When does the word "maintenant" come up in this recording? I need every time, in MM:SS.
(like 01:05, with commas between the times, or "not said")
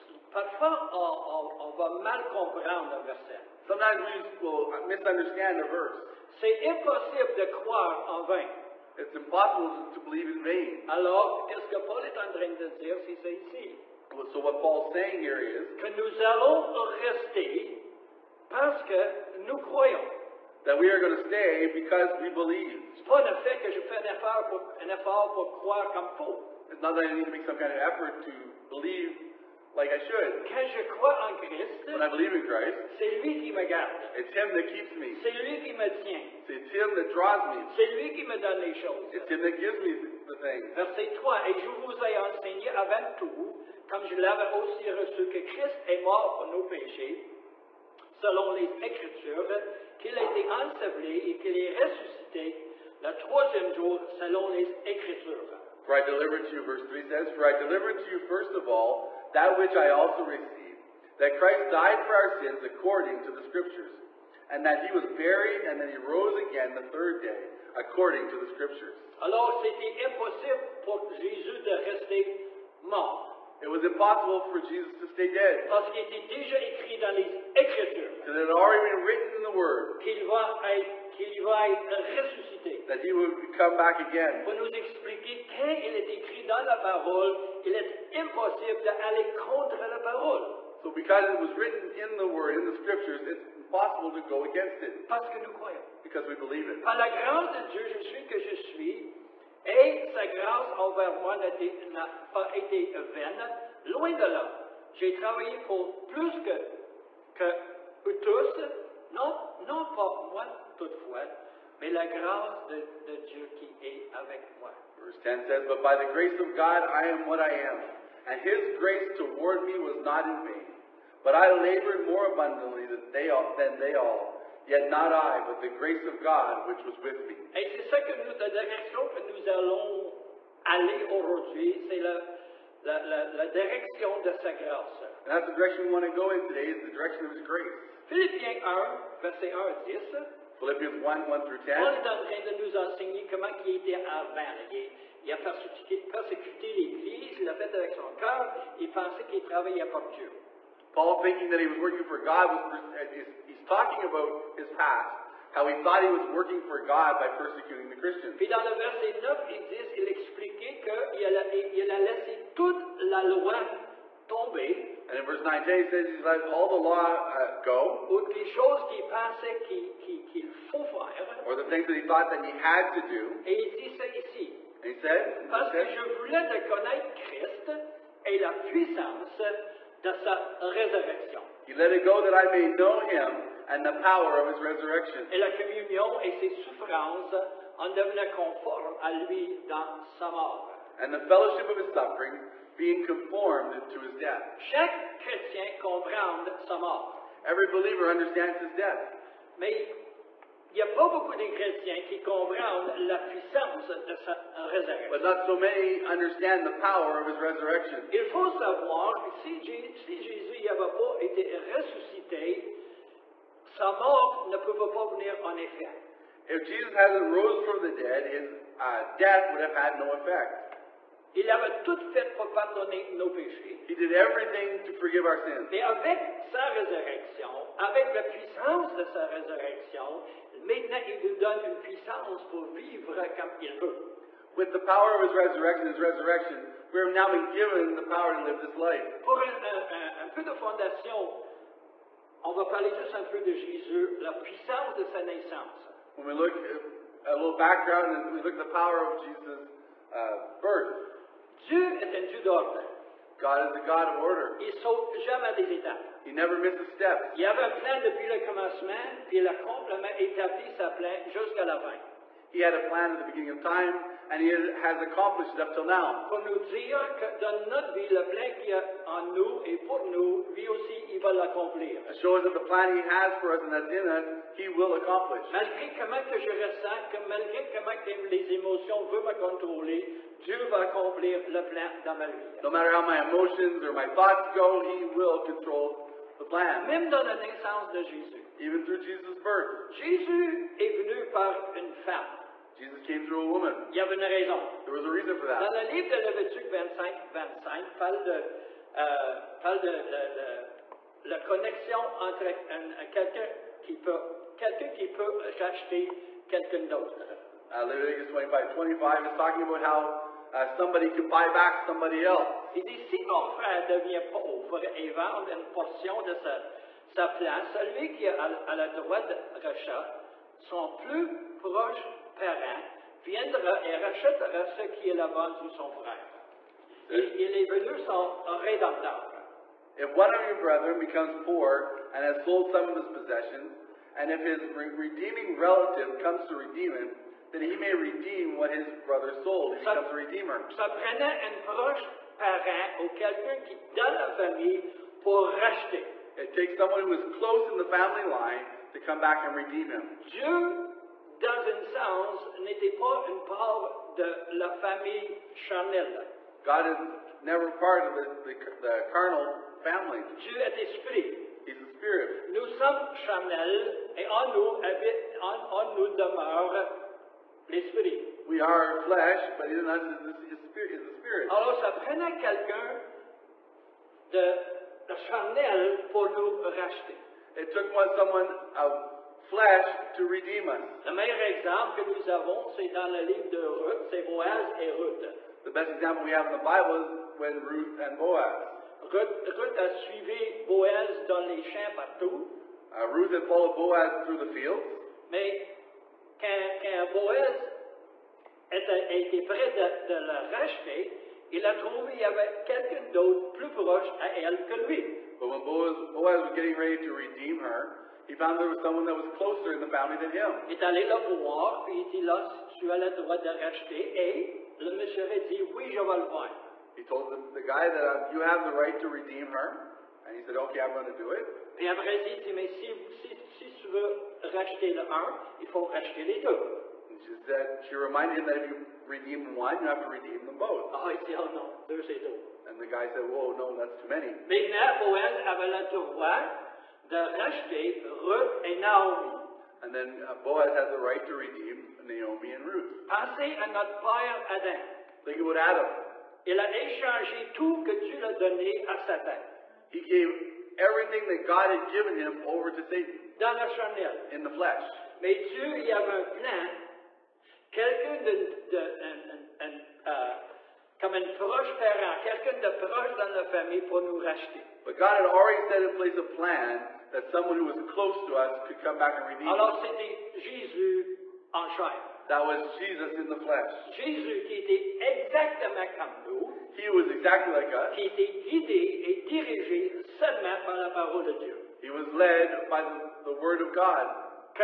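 03:50, 07:14.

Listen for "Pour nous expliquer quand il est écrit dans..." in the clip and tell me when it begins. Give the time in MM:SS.
01:24.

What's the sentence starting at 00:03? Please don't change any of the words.
Sometimes we will misunderstand a verse.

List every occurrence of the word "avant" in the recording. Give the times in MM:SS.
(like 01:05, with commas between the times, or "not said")
00:42, 02:24.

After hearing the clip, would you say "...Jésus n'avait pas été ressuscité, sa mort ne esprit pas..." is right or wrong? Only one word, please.
wrong.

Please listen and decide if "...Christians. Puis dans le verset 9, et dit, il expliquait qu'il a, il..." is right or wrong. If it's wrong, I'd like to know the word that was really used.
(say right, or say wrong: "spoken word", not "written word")
right.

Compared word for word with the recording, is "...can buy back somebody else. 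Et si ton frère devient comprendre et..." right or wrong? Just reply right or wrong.
wrong.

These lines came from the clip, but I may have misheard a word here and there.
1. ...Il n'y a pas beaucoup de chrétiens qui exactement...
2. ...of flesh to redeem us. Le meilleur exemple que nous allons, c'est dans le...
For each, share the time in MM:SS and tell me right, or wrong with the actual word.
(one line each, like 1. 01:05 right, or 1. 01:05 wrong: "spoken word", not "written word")
1. 03:20 wrong: "comprennent", not "exactement"
2. 06:18 wrong: "avons", not "allons".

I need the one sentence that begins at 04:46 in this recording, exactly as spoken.
Même dans la naissance de Jésus.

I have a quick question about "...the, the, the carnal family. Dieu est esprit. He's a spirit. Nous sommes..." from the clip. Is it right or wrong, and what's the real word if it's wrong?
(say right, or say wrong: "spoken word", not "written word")
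right.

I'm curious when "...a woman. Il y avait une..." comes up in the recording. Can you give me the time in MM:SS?
04:53.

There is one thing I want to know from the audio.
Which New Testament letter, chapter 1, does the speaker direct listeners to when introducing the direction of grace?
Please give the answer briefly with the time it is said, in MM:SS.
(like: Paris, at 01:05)
Philippians, at 02:20.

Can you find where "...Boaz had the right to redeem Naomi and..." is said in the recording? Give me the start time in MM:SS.
07:20.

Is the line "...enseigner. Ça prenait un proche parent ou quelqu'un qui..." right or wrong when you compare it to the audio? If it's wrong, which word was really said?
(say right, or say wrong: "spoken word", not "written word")
wrong: "redeemer", not "enseigner".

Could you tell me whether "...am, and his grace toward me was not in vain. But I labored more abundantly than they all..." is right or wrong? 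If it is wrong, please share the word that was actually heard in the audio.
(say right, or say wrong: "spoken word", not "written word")
right.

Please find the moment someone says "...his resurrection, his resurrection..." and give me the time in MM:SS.
03:55.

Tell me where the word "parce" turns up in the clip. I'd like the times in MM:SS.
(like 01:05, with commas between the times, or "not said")
00:18, 01:15, 01:35, 02:55.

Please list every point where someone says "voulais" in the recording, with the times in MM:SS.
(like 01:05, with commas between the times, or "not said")
02:56.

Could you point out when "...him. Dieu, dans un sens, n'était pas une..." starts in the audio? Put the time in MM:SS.
05:49.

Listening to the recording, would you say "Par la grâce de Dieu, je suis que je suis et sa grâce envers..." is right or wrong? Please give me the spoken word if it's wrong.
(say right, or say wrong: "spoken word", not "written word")
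right.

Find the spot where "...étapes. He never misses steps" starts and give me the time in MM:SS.
04:15.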